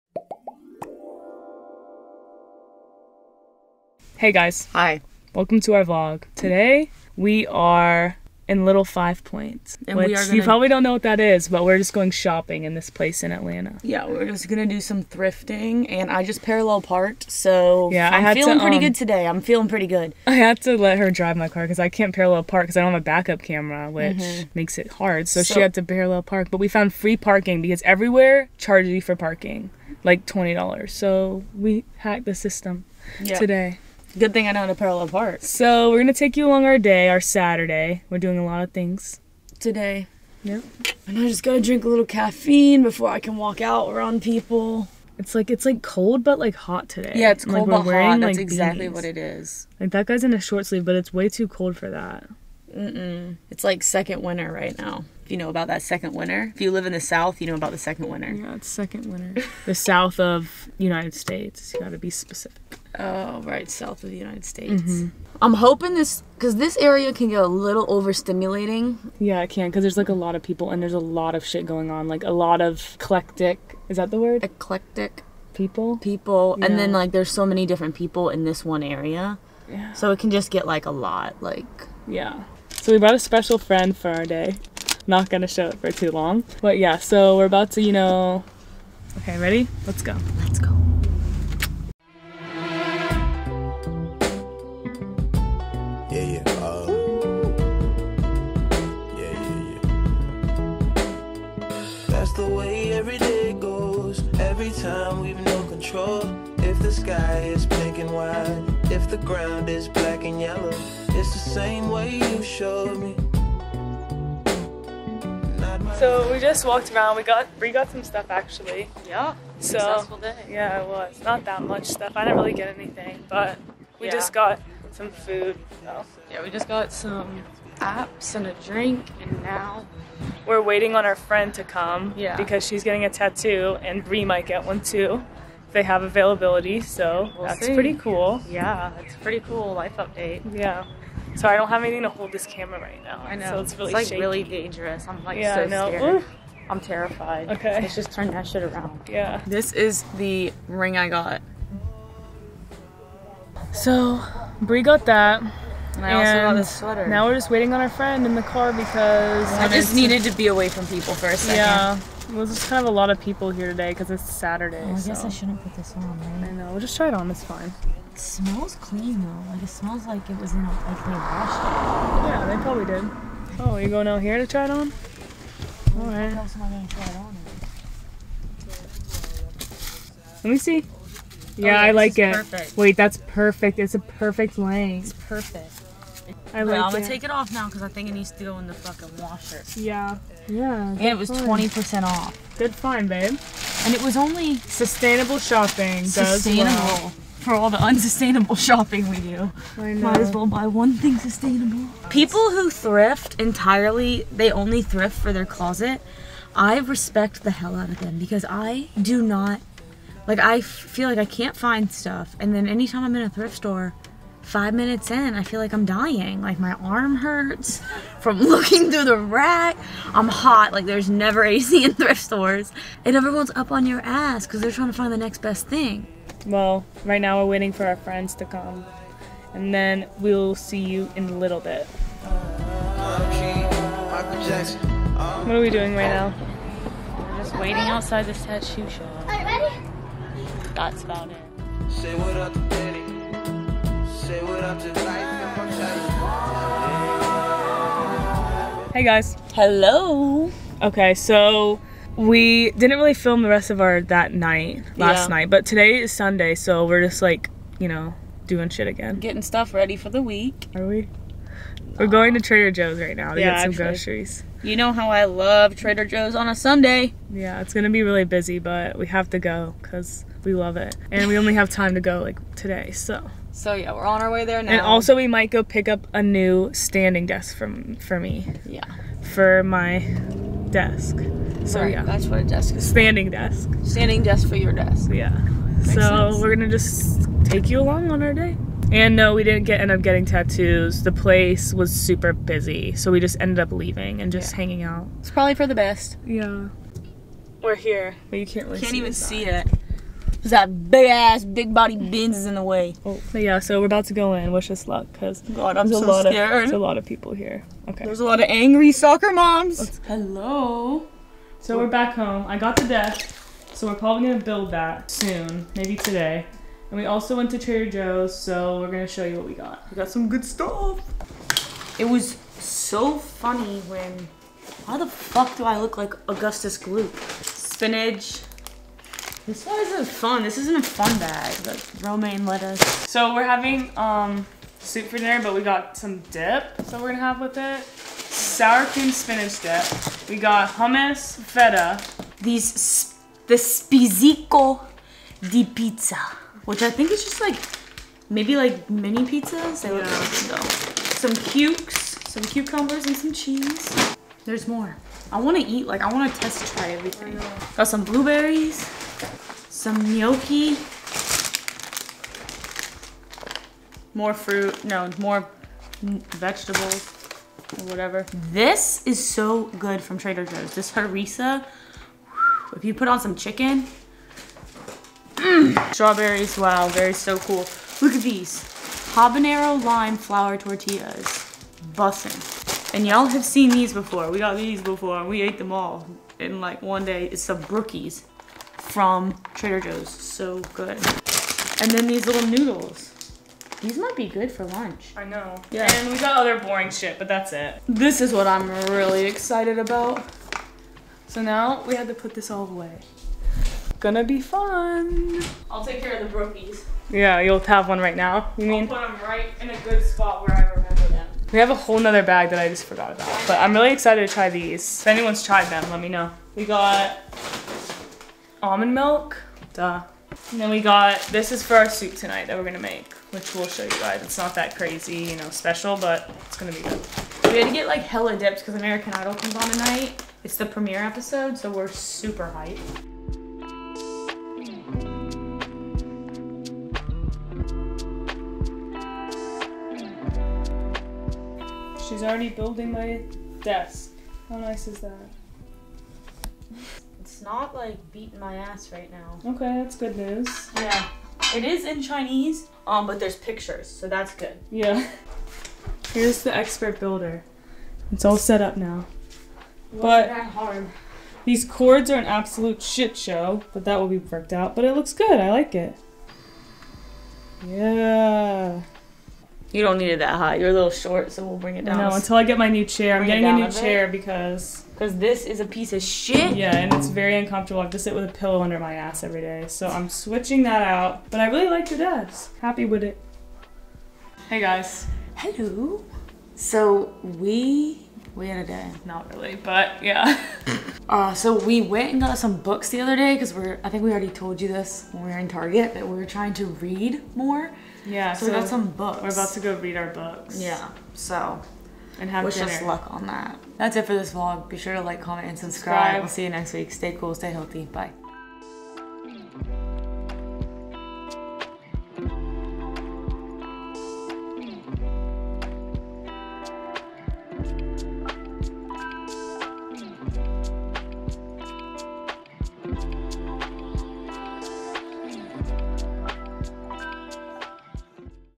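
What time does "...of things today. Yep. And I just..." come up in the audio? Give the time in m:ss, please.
0:38.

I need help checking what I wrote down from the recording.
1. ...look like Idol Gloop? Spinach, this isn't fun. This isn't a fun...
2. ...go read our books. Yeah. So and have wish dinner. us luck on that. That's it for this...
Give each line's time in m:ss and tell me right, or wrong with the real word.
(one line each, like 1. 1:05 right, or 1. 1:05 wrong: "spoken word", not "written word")
1. 5:25 wrong: "Augustus", not "Idol"
2. 8:19 right.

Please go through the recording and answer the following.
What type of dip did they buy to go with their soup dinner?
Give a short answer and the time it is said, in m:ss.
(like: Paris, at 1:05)
Sour cream spinach dip, at 5:38.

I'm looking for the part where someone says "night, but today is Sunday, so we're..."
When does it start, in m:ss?
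4:15.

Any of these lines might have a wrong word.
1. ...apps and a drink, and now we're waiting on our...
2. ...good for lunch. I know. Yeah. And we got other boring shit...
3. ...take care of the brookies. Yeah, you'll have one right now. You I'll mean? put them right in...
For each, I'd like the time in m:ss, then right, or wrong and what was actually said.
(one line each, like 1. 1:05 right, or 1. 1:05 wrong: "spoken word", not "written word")
1. 2:07 right
2. 6:34 right
3. 6:45 right.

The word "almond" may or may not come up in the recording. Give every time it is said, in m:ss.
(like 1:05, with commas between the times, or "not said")
6:58.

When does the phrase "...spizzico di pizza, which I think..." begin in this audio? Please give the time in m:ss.
5:43.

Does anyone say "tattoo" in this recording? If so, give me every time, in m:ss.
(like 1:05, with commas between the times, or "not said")
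2:13, 3:58, 4:50.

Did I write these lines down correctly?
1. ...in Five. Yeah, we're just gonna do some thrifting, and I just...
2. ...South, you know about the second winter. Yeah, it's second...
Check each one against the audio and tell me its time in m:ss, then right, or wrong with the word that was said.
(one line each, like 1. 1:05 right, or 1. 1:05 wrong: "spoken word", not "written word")
1. 0:13 wrong: "Atlanta", not "Five"
2. 0:57 right.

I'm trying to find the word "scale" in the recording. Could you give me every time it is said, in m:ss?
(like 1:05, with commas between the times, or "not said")
not said.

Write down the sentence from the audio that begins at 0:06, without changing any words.
Today we are in Little Five Points, and which gonna...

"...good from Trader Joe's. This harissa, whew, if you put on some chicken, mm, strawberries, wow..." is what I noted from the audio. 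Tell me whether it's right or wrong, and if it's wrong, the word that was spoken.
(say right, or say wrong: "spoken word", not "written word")
right.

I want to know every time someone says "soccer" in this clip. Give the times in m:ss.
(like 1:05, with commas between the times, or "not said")
5:08.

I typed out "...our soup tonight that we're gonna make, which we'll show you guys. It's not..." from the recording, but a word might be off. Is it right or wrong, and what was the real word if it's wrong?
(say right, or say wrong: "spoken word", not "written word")
right.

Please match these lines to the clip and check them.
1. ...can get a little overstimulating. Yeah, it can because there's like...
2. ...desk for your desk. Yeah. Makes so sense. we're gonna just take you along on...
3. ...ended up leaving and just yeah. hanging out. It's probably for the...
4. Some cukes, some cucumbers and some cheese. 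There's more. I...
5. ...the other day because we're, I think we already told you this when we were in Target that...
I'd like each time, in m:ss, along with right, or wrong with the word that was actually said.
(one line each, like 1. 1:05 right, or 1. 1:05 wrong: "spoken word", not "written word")
1. 1:07 right
2. 4:44 right
3. 4:53 right
4. 5:51 right
5. 8:12 right.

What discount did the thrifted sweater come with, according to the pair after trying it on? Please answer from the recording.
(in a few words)
20% off.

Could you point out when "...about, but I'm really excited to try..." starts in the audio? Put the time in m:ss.
6:53.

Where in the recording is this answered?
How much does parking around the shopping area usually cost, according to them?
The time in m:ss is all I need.
0:30.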